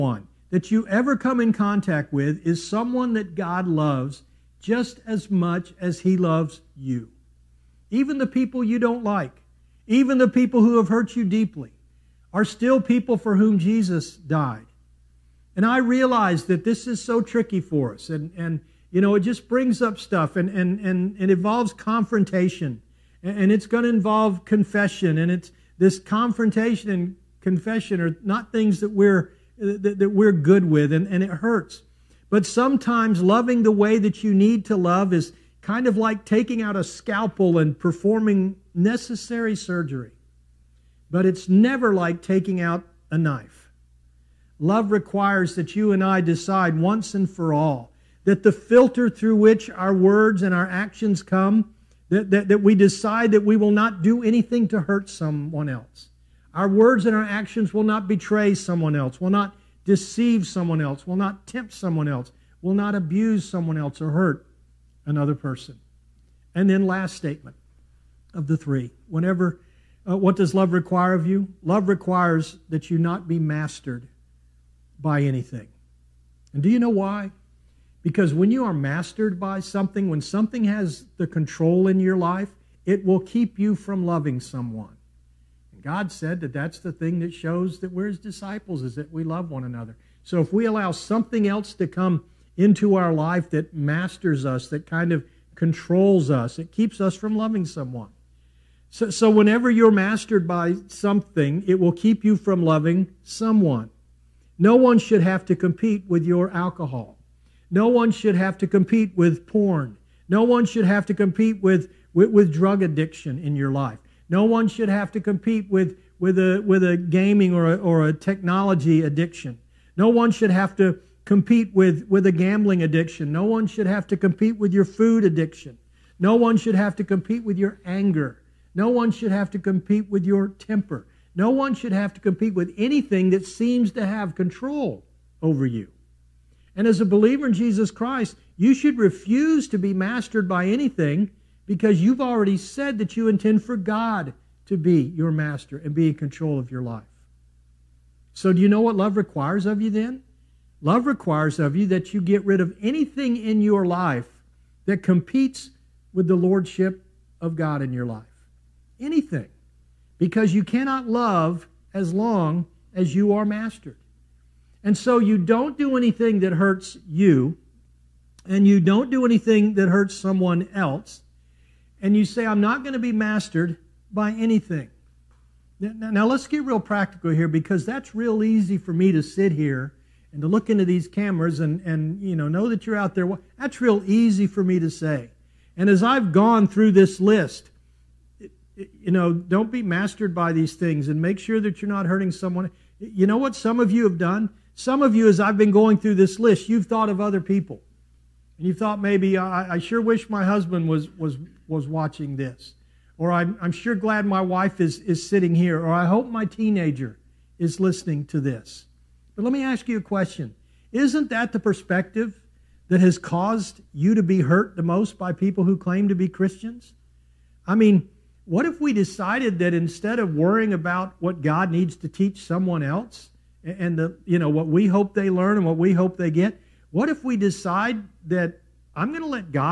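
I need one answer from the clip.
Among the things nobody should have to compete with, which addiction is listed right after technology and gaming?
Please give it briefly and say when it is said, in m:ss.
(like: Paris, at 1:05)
gambling addiction, at 2:02.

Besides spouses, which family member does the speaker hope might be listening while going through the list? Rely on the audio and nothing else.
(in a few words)
teenager.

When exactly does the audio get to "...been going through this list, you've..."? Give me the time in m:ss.
3:15.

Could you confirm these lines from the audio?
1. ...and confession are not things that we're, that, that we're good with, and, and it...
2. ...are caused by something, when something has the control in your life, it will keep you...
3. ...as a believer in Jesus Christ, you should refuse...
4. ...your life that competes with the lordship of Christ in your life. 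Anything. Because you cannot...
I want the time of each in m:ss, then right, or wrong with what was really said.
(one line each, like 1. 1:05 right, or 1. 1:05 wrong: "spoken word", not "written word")
1. 0:26 right
2. 1:18 wrong: "mastered", not "caused"
3. 2:16 right
4. 2:33 wrong: "God", not "Christ".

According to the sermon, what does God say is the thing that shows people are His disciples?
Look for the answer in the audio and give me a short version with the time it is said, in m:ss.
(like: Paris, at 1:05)
we love one another, at 1:29.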